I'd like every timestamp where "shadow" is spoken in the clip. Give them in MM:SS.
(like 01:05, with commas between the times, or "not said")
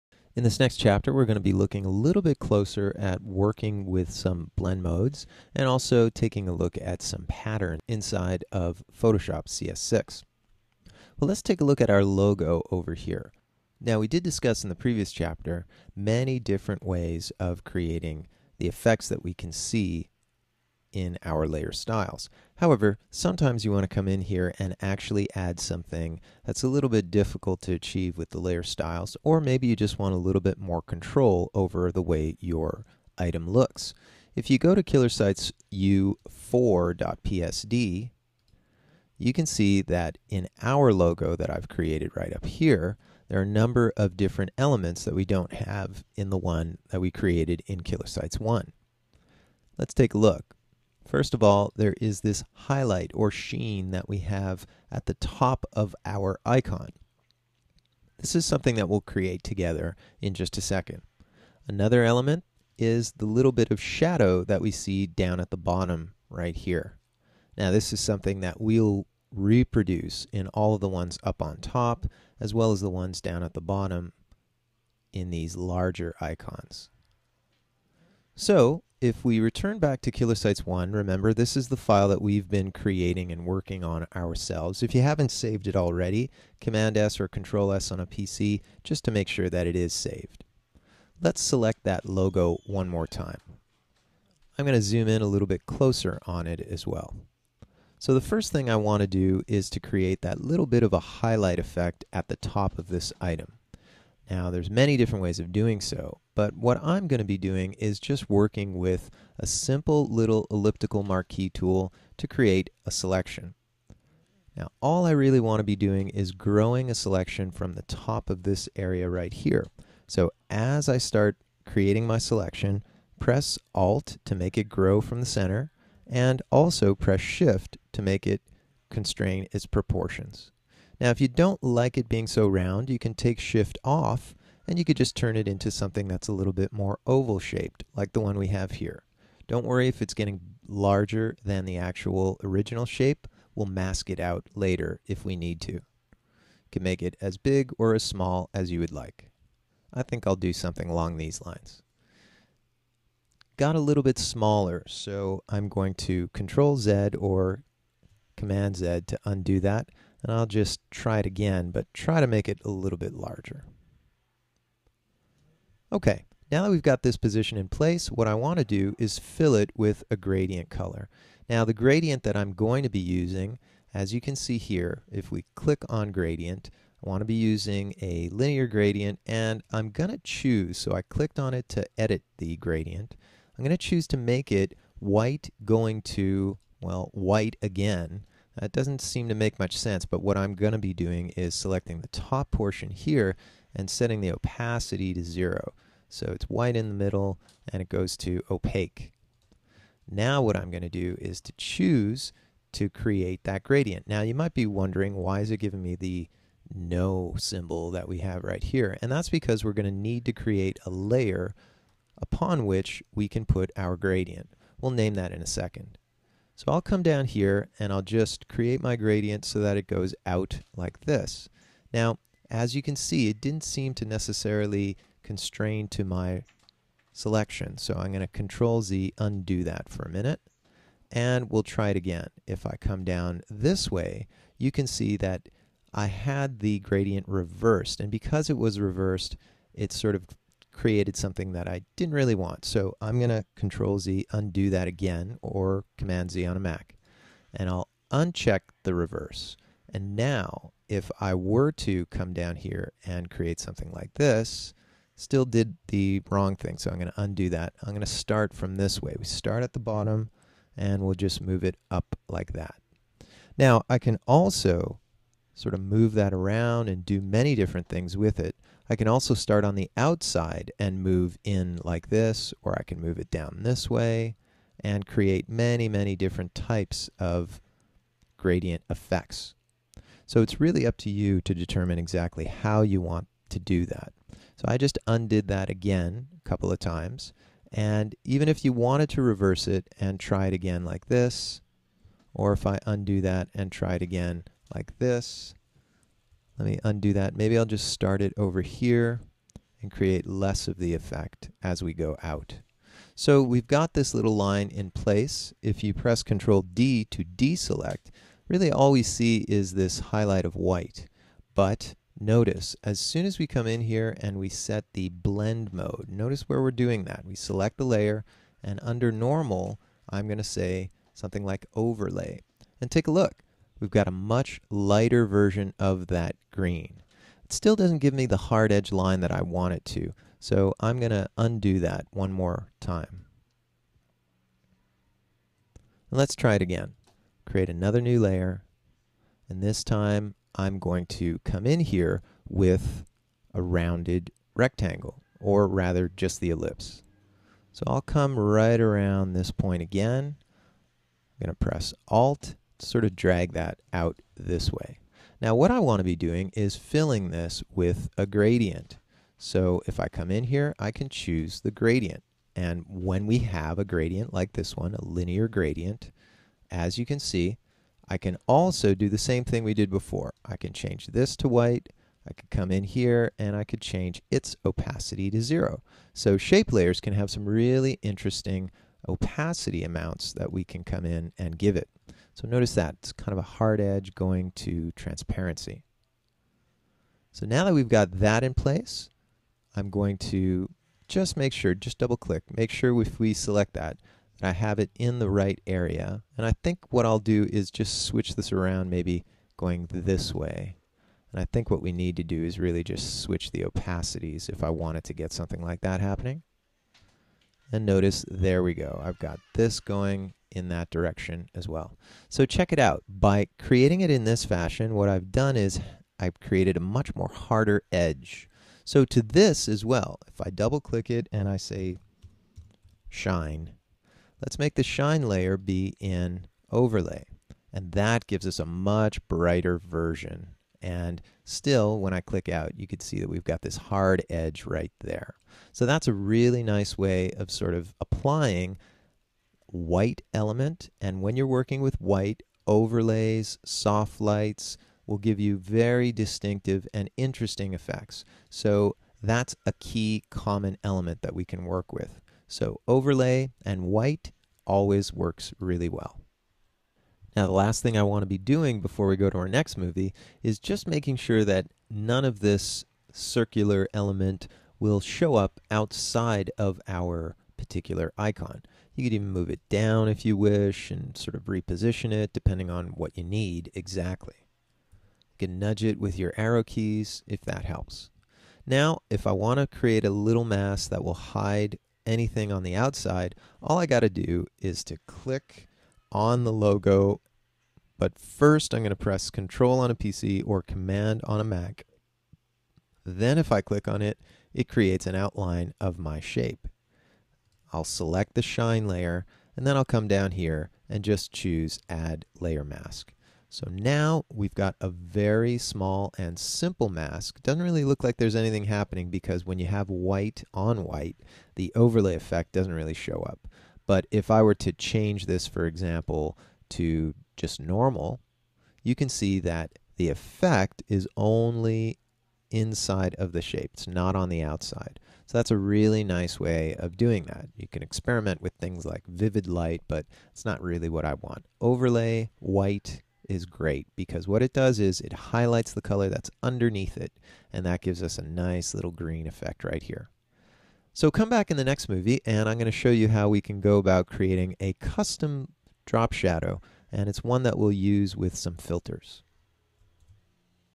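01:03, 09:06.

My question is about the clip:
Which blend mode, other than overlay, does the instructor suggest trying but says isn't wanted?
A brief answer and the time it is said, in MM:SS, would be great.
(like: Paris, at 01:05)
vivid light, at 08:49.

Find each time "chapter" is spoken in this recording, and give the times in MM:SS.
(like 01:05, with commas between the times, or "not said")
00:00, 00:15.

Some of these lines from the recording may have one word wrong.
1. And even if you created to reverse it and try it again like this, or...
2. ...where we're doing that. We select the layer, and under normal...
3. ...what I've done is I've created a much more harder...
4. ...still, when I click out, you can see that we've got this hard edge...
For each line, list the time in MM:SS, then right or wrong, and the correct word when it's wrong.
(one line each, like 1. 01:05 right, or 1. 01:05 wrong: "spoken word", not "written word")
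1. 04:47 wrong: "wanted", not "created"
2. 05:16 right
3. 06:54 right
4. 07:11 right.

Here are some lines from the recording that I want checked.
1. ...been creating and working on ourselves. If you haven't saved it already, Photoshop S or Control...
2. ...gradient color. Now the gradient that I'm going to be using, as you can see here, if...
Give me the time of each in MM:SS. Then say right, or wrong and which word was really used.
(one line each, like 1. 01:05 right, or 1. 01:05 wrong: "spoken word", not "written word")
1. 01:22 wrong: "Command", not "Photoshop"
2. 02:50 right.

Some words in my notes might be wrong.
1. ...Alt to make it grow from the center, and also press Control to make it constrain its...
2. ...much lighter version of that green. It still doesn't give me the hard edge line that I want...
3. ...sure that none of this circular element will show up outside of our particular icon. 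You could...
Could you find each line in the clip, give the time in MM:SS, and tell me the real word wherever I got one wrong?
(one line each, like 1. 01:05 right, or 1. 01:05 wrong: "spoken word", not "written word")
1. 02:03 wrong: "Shift", not "Control"
2. 05:24 right
3. 07:41 right.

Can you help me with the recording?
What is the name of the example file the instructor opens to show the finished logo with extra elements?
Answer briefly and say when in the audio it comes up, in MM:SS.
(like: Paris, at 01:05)
KillerSites u4.psd, at 00:34.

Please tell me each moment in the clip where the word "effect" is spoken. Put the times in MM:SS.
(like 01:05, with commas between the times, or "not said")
00:18, 01:41, 04:38, 05:00, 07:27, 08:32, 08:40, 08:59.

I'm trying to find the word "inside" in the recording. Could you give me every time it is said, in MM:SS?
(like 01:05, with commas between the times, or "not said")
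00:07, 08:42.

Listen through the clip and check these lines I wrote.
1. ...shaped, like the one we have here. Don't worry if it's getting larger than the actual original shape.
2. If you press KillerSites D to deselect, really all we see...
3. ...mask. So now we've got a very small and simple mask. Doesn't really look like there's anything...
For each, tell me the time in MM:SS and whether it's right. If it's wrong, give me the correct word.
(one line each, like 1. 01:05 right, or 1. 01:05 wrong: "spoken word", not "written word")
1. 02:17 right
2. 05:05 wrong: "Control", not "KillerSites"
3. 08:22 right.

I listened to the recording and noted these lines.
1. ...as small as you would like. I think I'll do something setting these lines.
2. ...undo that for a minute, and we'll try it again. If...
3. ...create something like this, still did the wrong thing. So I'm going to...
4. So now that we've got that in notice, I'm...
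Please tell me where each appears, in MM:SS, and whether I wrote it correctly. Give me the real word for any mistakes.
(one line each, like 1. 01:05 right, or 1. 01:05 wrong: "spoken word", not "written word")
1. 02:27 wrong: "along", not "setting"
2. 03:49 right
3. 04:13 right
4. 06:27 wrong: "place", not "notice".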